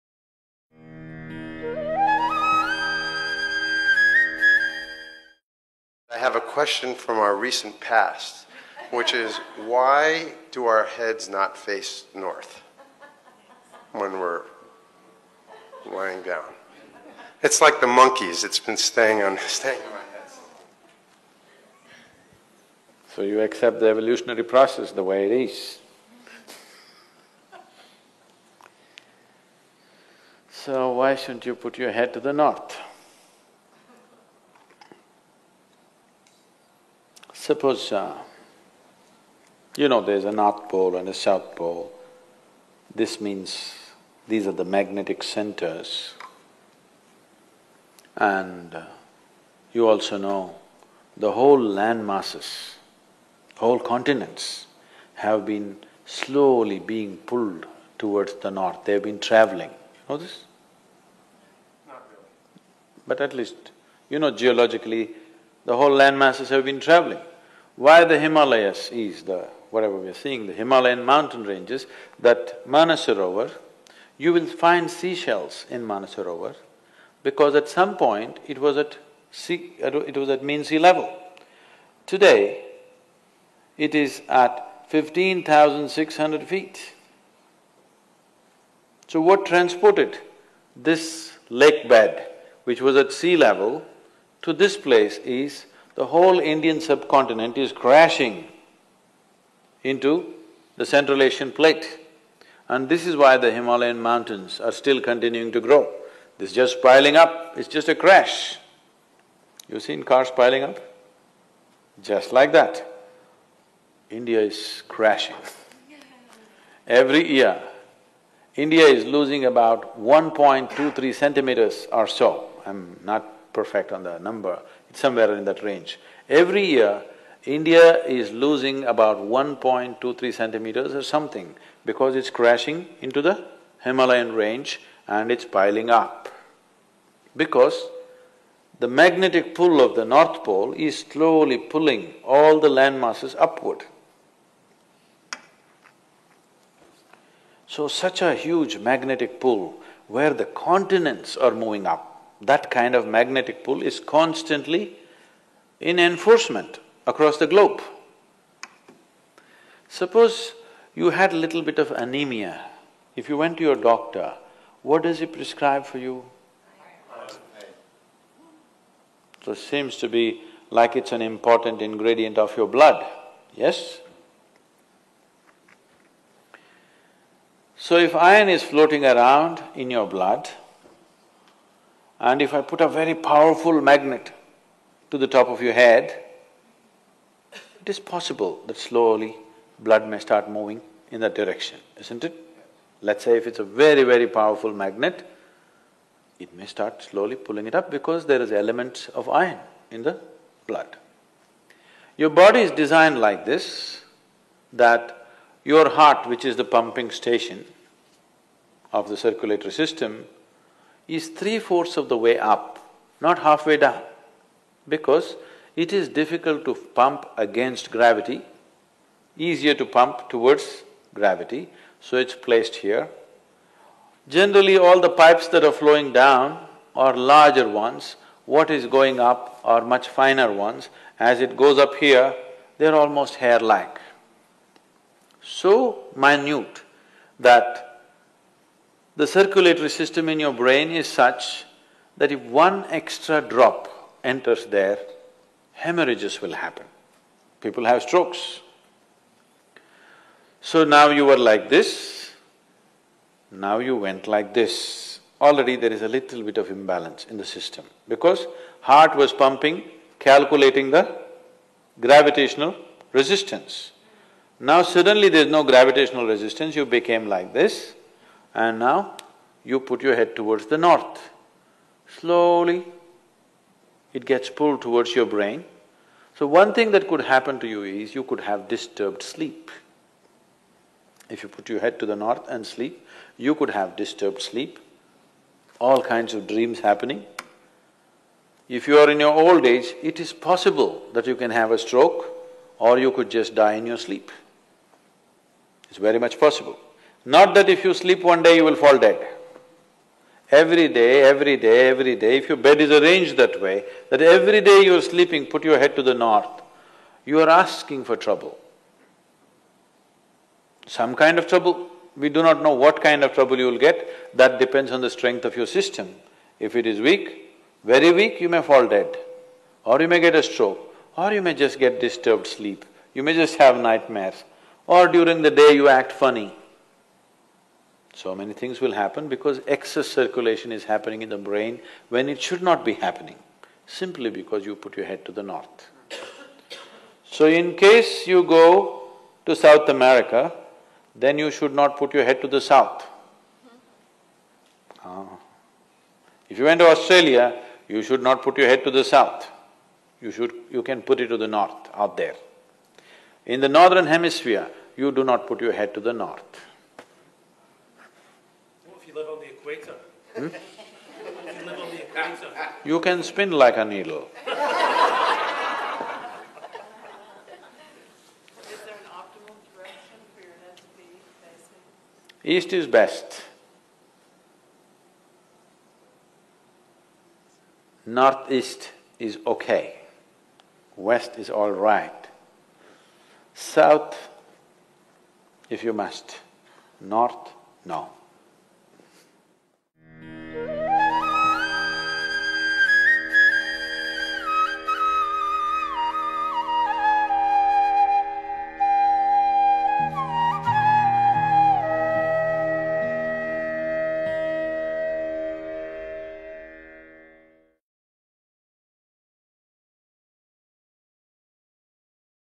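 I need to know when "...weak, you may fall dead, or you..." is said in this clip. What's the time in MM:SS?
05:18.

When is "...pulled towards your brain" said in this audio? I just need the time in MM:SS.
04:34.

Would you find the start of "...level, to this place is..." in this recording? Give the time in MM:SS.
01:33.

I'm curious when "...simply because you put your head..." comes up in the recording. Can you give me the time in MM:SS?
05:33.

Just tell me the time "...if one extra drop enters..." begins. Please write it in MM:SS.
04:02.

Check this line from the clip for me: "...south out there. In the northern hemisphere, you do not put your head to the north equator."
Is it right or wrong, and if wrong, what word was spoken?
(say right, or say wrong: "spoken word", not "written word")
wrong: "north", not "south".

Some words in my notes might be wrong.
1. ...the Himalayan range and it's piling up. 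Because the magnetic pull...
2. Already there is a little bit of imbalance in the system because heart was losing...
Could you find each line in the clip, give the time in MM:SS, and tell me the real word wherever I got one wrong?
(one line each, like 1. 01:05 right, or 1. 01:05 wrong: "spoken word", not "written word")
1. 02:13 right
2. 04:15 wrong: "pumping", not "losing".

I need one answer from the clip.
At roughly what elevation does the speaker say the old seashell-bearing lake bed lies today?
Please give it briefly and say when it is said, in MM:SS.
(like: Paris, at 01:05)
15,600 feet, at 01:24.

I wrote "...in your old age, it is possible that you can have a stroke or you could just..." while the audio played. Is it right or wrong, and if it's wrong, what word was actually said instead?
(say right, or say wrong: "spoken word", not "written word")
right.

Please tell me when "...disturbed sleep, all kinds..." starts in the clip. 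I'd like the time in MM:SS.
04:43.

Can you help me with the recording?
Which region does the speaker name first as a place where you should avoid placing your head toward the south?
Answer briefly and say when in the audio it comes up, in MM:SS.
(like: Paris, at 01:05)
South America, at 05:39.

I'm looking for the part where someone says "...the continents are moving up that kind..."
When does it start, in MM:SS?
02:30.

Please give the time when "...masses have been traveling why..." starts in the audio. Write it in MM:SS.
01:06.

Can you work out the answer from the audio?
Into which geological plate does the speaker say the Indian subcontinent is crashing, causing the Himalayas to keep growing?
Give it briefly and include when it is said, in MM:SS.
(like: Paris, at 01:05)
Central Asian plate, at 01:40.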